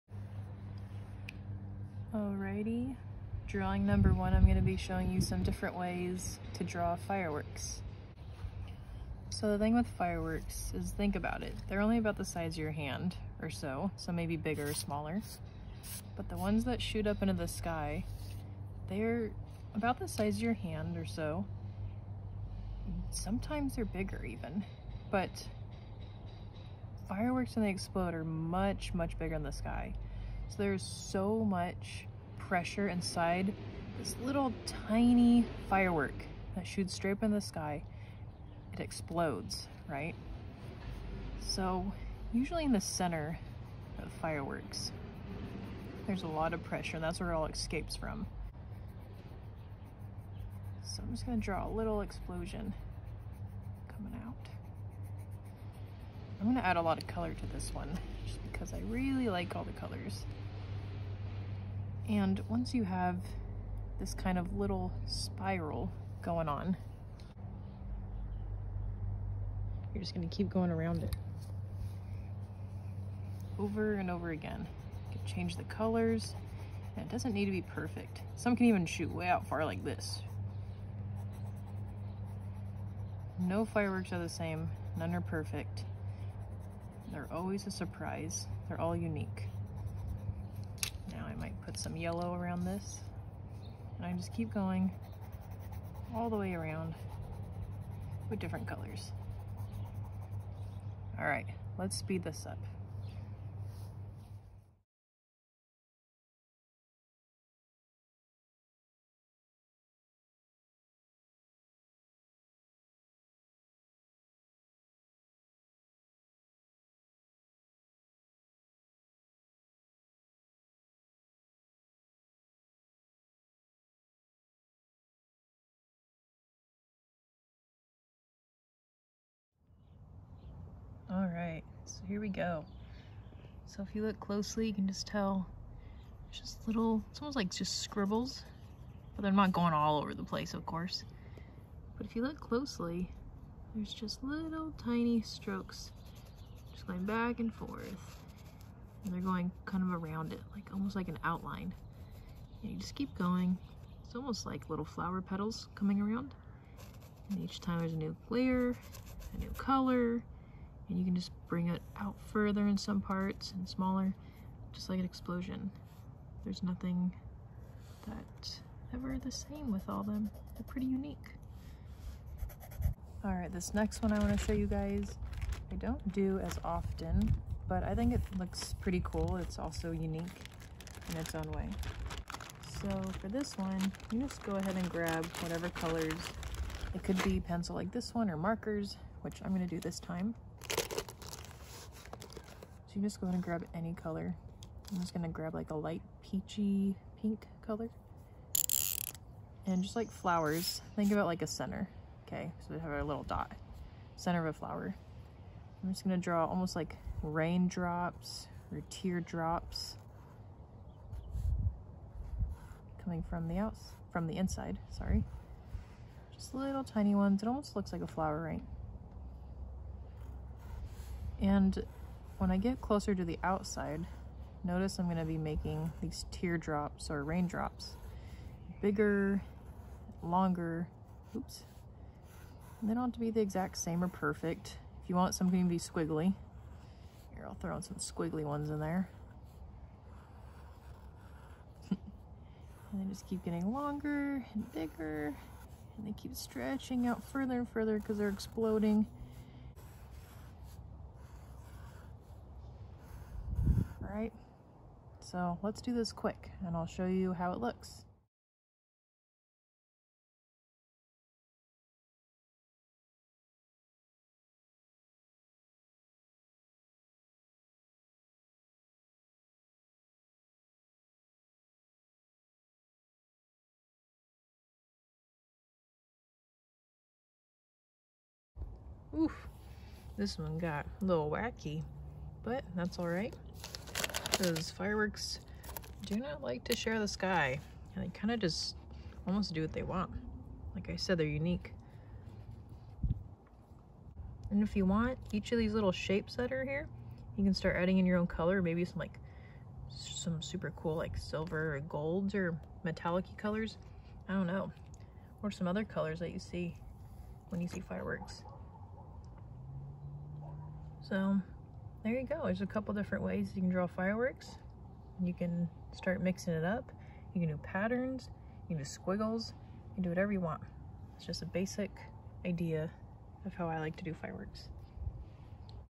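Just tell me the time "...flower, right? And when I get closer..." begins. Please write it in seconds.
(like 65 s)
218 s.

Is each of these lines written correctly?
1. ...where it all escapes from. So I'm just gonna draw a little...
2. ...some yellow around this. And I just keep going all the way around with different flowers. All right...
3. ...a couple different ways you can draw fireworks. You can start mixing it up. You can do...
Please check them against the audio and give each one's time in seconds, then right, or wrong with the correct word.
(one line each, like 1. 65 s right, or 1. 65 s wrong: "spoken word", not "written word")
1. 47 s right
2. 91 s wrong: "colors", not "flowers"
3. 312 s right.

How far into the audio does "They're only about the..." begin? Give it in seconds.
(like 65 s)
11 s.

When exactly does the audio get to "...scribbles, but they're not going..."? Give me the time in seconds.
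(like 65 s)
137 s.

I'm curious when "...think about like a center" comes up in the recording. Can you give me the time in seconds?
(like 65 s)
200 s.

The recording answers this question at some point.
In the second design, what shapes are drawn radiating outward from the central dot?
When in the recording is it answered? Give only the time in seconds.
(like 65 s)
207 s.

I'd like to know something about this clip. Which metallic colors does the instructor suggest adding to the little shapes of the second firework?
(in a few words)
Silver or golds.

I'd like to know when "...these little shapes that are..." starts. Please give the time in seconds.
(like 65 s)
295 s.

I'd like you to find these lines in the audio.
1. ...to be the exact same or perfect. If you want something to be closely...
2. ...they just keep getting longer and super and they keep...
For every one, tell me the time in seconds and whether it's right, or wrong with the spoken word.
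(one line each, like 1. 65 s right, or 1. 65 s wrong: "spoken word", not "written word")
1. 233 s wrong: "squiggly", not "closely"
2. 242 s wrong: "bigger", not "super".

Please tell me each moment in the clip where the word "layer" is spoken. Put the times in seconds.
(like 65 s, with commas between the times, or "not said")
158 s.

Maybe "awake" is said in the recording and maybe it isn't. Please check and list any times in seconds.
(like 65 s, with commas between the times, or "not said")
not said.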